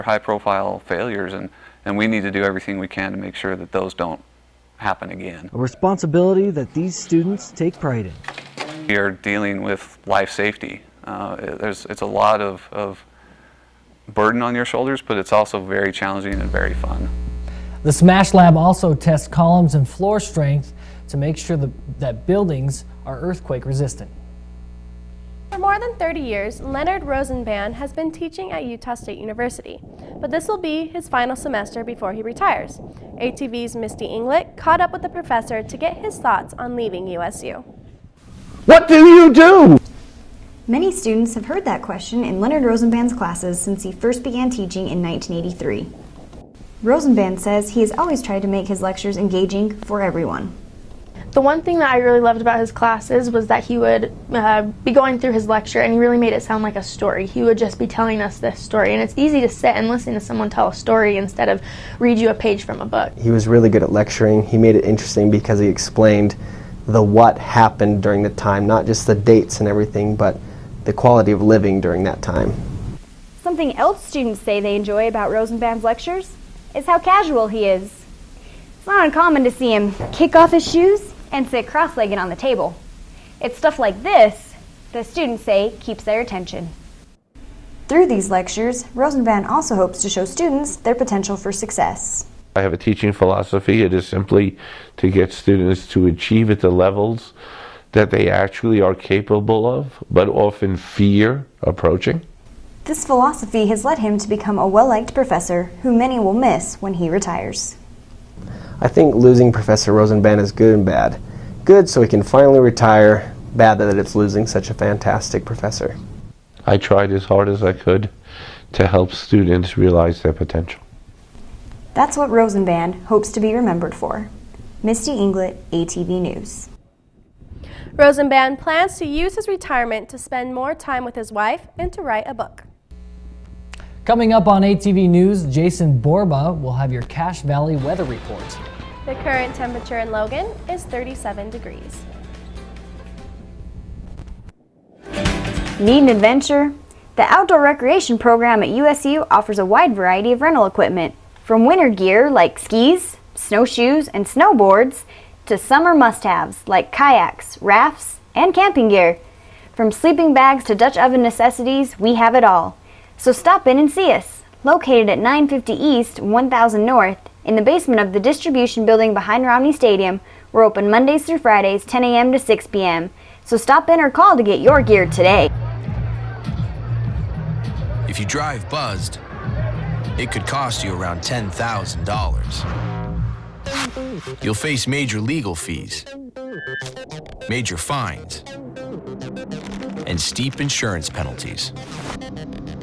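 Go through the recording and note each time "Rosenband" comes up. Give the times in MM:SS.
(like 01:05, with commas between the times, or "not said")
00:27, 00:42, 00:46, 01:15, 01:28, 01:49, 02:02, 02:07.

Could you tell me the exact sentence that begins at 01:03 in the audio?
He was really good at lecturing.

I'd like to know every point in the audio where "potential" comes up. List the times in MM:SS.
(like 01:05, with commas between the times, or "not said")
01:30, 02:00.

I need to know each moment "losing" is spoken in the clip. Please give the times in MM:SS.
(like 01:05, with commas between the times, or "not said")
01:49, 01:54.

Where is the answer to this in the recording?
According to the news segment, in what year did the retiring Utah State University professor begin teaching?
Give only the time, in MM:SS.
00:45.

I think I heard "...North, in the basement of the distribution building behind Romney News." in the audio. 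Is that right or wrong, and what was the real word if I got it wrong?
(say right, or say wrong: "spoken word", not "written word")
wrong: "Stadium", not "News".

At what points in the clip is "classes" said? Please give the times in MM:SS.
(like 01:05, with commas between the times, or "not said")
00:43, 00:52.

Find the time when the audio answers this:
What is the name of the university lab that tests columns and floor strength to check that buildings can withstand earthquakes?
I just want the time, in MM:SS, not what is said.
00:17.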